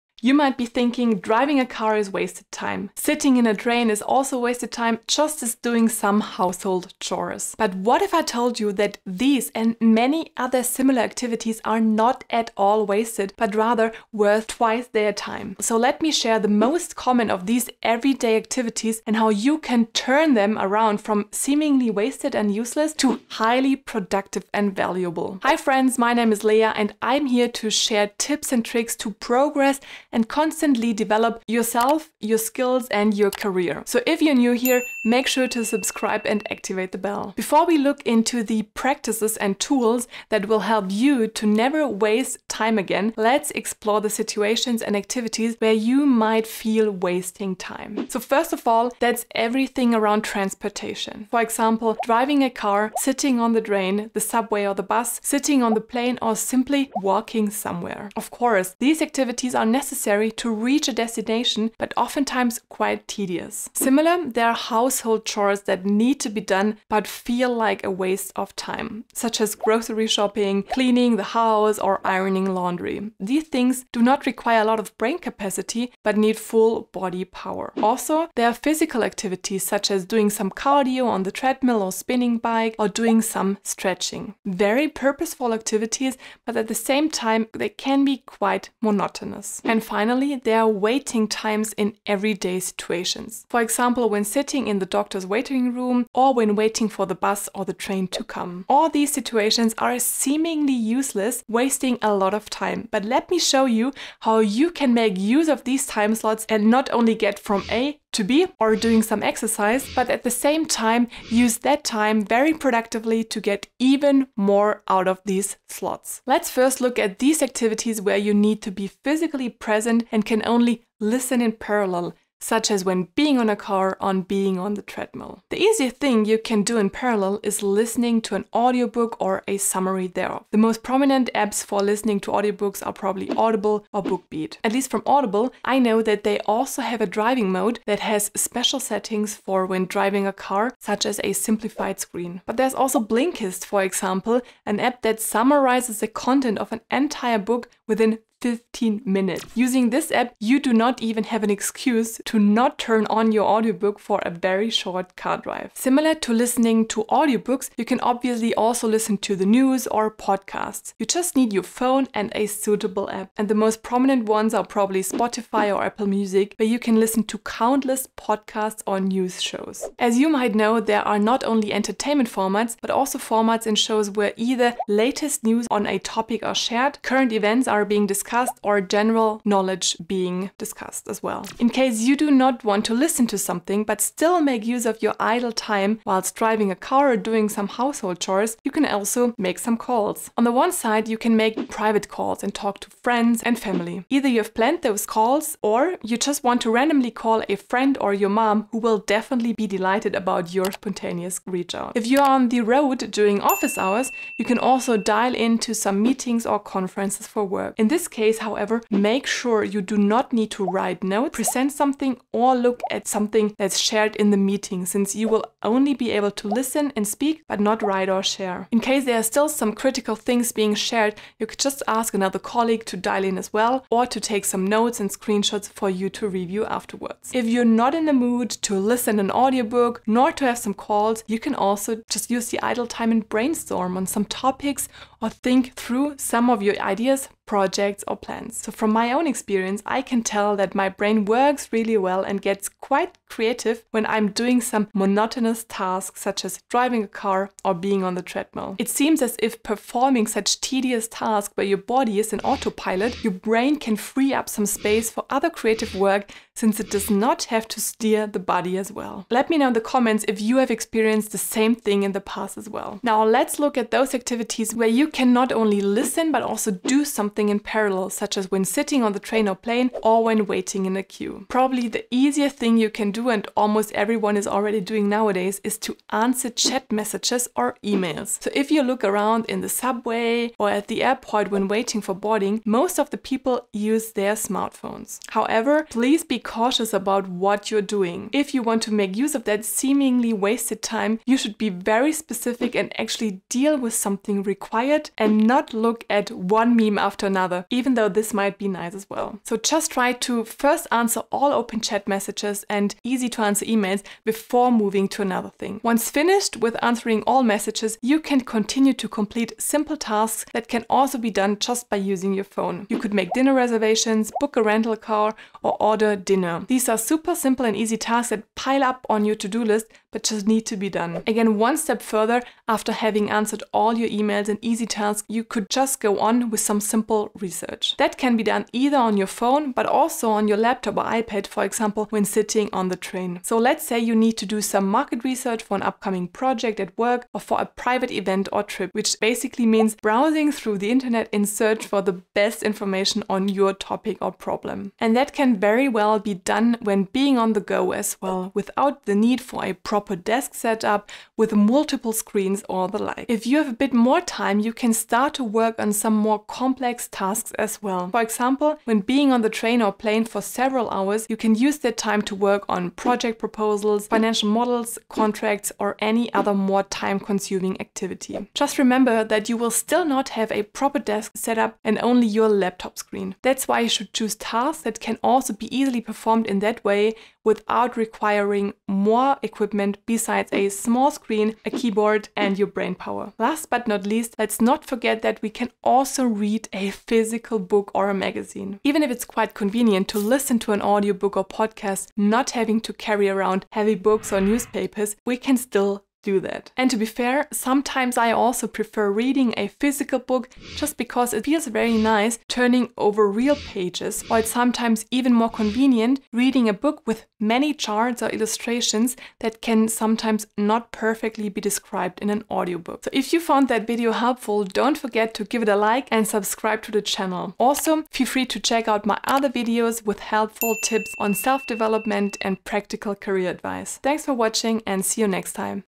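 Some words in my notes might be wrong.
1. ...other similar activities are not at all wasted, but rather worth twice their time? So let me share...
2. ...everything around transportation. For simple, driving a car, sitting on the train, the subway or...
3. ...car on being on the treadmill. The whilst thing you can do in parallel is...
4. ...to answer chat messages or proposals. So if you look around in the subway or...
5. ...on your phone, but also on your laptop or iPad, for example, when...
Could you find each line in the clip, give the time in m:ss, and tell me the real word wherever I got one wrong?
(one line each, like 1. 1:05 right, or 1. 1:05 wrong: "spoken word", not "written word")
1. 0:10 right
2. 0:49 wrong: "example", not "simple"
3. 2:03 wrong: "easiest", not "whilst"
4. 4:35 wrong: "emails", not "proposals"
5. 5:28 right.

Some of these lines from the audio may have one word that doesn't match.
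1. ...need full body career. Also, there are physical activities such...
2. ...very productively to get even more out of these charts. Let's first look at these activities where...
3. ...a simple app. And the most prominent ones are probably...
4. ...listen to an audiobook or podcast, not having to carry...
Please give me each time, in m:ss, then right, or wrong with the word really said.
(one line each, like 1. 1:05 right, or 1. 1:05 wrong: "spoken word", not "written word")
1. 1:16 wrong: "power", not "career"
2. 1:52 wrong: "slots", not "charts"
3. 2:42 wrong: "suitable", not "simple"
4. 6:30 right.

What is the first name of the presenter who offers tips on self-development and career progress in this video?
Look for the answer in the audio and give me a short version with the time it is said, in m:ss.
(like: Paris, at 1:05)
Lea, at 0:26.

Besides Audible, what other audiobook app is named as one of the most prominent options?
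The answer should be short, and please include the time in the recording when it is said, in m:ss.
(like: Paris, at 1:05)
BookBeat, at 2:14.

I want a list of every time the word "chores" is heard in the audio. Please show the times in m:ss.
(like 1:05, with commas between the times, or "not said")
0:06, 1:05, 3:08.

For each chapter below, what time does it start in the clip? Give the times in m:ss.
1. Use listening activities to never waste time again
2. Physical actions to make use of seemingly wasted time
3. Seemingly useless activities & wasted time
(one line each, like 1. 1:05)
1. 1:56
2. 4:22
3. 0:37.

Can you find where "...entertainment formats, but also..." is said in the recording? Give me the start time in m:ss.
2:51.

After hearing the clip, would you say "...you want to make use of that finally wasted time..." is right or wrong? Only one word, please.
wrong.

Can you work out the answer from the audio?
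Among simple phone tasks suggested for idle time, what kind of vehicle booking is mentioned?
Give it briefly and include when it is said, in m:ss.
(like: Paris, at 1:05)
rental car, at 5:14.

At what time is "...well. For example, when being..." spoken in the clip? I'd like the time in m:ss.
5:57.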